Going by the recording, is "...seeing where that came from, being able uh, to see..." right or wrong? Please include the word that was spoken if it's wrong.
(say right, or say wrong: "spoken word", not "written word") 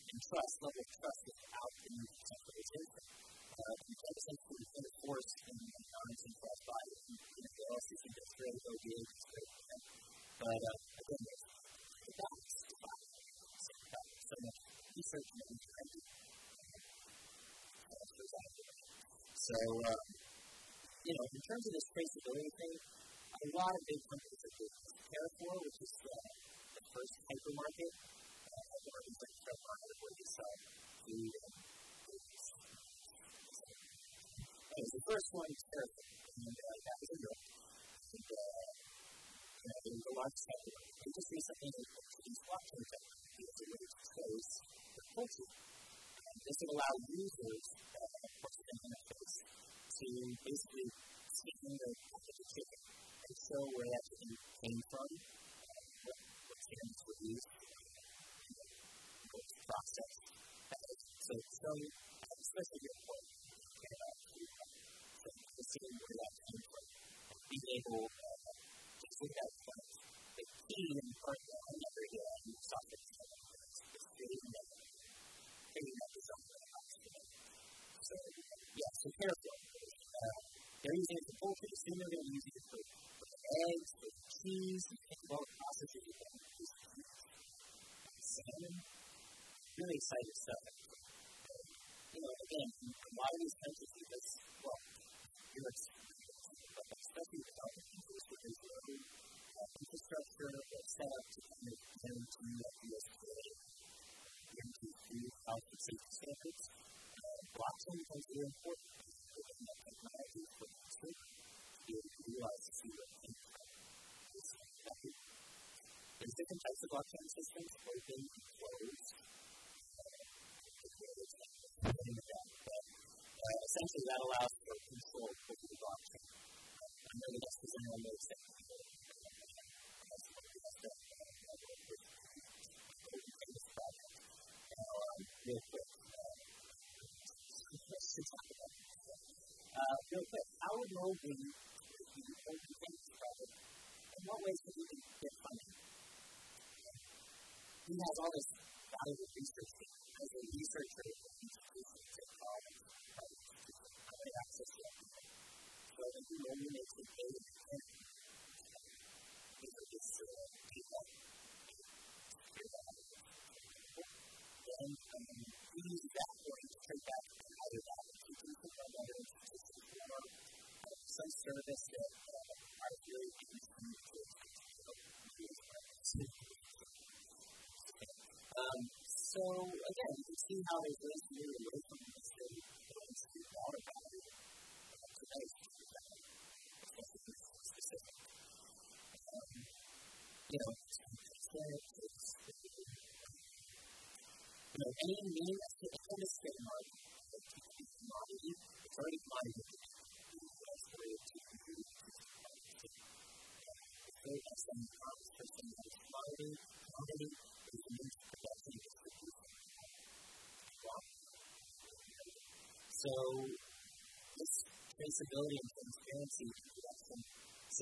right.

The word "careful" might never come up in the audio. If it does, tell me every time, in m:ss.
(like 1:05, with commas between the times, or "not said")
1:19.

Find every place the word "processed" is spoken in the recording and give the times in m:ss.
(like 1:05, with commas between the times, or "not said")
0:59.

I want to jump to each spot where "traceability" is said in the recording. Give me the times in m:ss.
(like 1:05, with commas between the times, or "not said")
0:21, 3:34.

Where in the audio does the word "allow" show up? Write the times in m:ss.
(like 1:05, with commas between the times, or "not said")
0:46, 2:04.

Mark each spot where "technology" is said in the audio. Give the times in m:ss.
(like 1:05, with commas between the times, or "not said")
1:49, 2:32.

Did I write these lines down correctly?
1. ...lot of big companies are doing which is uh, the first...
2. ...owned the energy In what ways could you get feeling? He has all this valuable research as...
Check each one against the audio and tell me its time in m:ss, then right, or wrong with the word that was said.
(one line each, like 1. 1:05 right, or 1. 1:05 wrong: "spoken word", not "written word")
1. 0:23 right
2. 2:22 wrong: "funding", not "feeling".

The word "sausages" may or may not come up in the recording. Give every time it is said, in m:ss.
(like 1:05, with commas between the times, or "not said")
1:25.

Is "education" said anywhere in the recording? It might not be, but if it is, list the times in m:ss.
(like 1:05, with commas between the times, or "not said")
2:31.